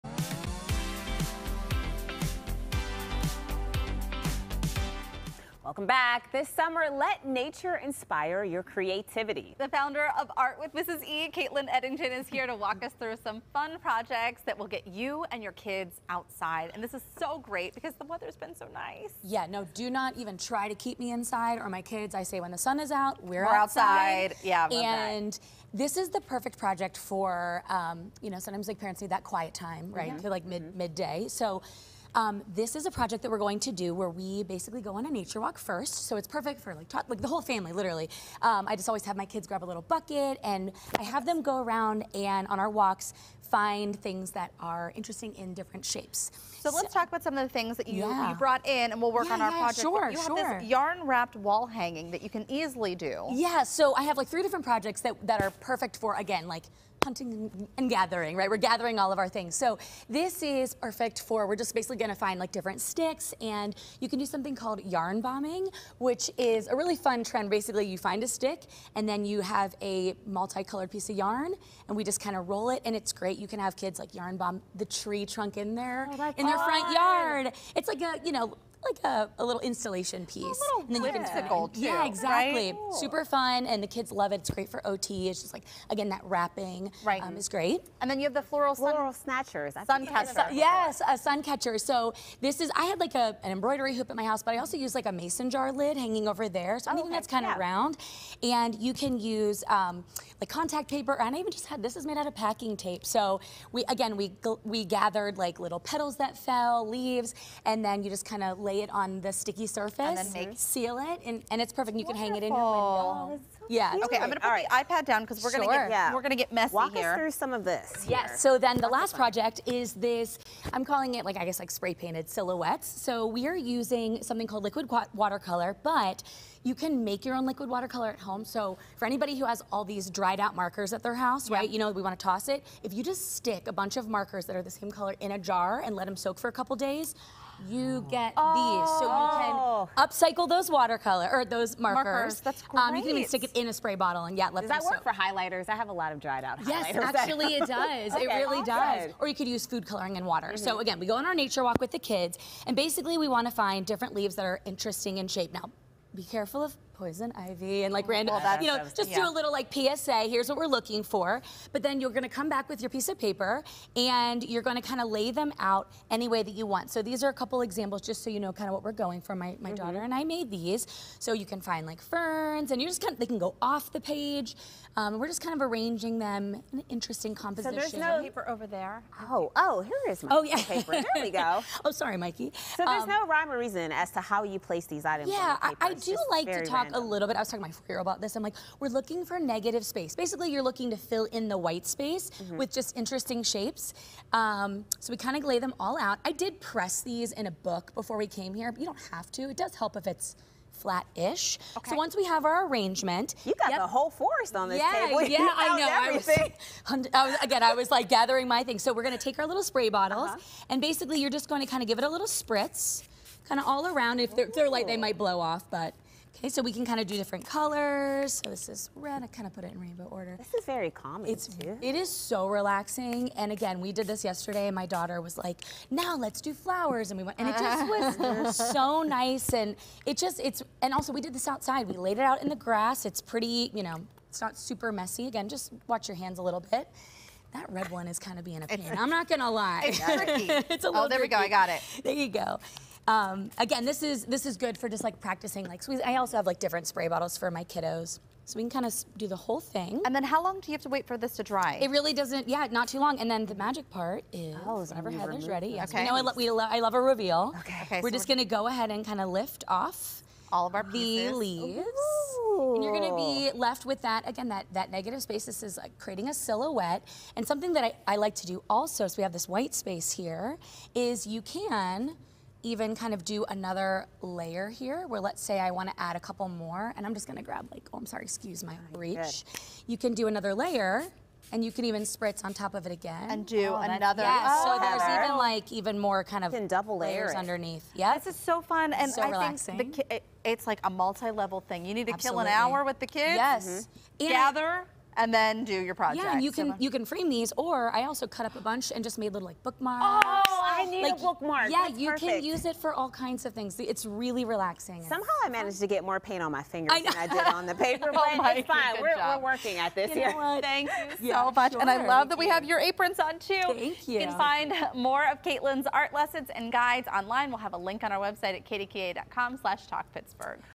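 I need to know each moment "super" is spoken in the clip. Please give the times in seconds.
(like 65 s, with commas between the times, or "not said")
82 s, 234 s.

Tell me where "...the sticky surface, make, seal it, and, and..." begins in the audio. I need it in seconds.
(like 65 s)
109 s.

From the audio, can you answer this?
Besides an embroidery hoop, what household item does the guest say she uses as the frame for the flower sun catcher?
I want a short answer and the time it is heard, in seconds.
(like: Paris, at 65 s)
mason jar lid, at 95 s.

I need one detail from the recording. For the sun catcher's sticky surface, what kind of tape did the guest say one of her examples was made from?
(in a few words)
packing tape.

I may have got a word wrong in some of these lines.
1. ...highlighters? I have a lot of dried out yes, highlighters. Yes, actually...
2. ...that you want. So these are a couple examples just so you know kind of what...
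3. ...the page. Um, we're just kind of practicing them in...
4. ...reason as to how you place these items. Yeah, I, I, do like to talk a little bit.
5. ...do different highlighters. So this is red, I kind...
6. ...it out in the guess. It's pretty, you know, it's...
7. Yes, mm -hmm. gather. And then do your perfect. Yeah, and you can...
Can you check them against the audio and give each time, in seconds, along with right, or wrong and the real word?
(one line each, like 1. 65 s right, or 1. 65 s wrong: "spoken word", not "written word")
1. 145 s right
2. 166 s right
3. 173 s wrong: "arranging", not "practicing"
4. 183 s right
5. 217 s wrong: "colors", not "highlighters"
6. 232 s wrong: "grass", not "guess"
7. 293 s wrong: "project", not "perfect".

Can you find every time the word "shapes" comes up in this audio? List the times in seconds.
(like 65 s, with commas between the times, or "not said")
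45 s, 155 s, 193 s.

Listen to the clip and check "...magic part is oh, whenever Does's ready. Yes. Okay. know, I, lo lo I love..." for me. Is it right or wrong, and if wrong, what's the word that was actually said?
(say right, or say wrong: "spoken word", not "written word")
wrong: "Heather", not "Does".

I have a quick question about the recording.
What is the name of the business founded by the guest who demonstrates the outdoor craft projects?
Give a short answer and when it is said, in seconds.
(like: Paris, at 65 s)
Art with Mrs. E, at 10 s.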